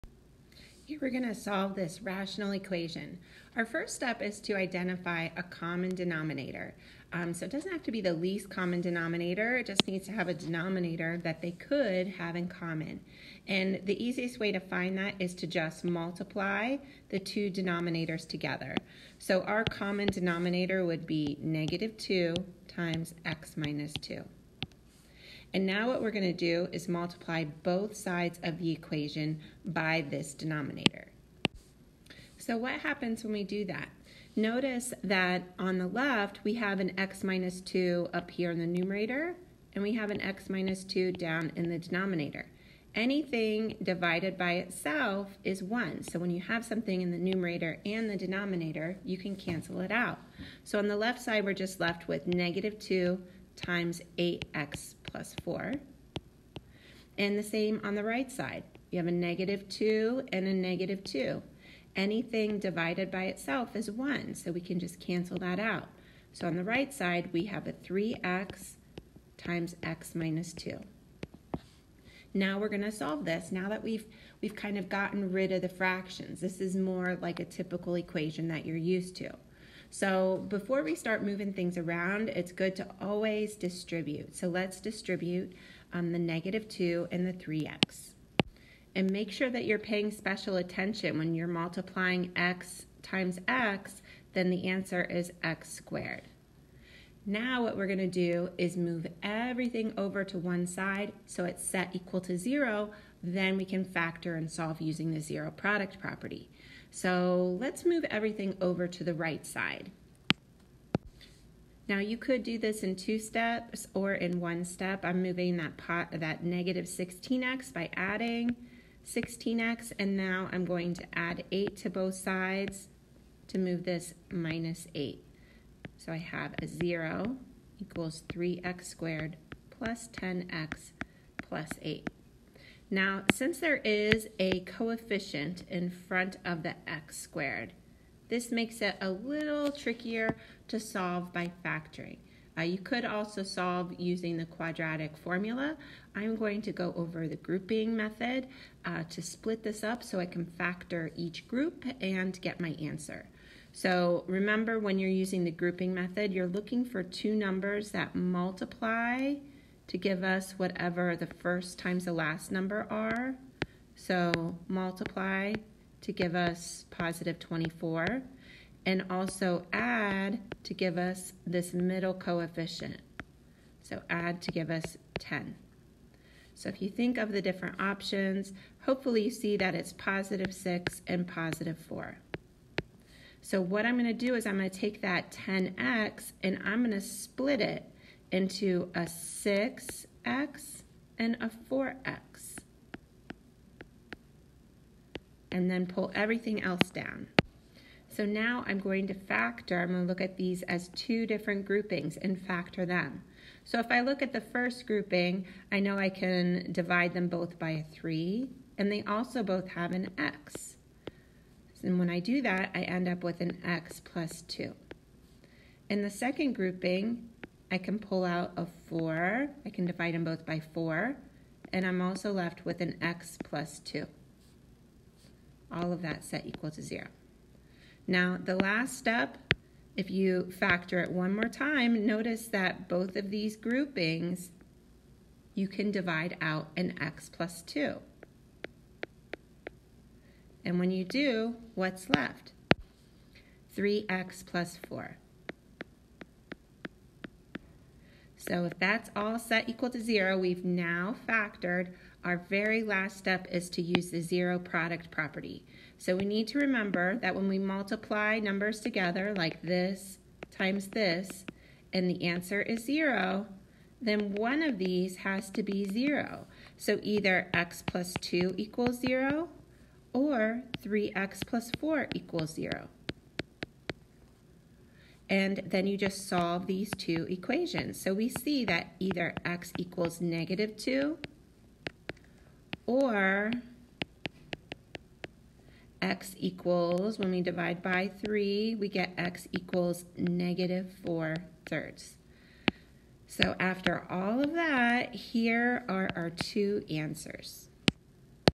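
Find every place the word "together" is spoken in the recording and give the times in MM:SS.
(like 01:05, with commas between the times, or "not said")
00:18, 04:18.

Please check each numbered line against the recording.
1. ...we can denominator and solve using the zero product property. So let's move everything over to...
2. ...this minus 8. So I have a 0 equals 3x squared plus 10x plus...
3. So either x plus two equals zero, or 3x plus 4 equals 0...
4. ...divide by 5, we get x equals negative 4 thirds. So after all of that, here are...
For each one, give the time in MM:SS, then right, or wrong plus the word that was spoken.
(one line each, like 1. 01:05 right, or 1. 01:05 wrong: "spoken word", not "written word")
1. 01:43 wrong: "factor", not "denominator"
2. 02:03 right
3. 04:26 right
4. 04:47 wrong: "3", not "5".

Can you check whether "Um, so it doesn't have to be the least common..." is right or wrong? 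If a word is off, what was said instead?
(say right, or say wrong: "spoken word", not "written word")
right.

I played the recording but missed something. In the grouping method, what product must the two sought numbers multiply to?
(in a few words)
24.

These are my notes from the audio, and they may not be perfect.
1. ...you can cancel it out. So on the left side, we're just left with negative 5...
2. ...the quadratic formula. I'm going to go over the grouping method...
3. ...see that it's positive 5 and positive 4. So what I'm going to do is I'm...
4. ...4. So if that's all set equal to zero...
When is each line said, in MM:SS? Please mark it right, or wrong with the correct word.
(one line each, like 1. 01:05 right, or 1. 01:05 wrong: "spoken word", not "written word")
1. 00:49 wrong: "2", not "5"
2. 02:24 right
3. 02:59 wrong: "6", not "5"
4. 04:04 right.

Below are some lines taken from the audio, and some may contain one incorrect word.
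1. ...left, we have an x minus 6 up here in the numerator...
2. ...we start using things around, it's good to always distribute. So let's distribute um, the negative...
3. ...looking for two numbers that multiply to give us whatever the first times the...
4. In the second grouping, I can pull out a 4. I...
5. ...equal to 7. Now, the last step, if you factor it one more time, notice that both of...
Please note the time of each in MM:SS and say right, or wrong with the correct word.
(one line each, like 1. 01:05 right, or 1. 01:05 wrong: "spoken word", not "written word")
1. 00:35 wrong: "2", not "6"
2. 01:20 wrong: "moving", not "using"
3. 02:36 right
4. 03:35 right
5. 03:46 wrong: "0", not "7".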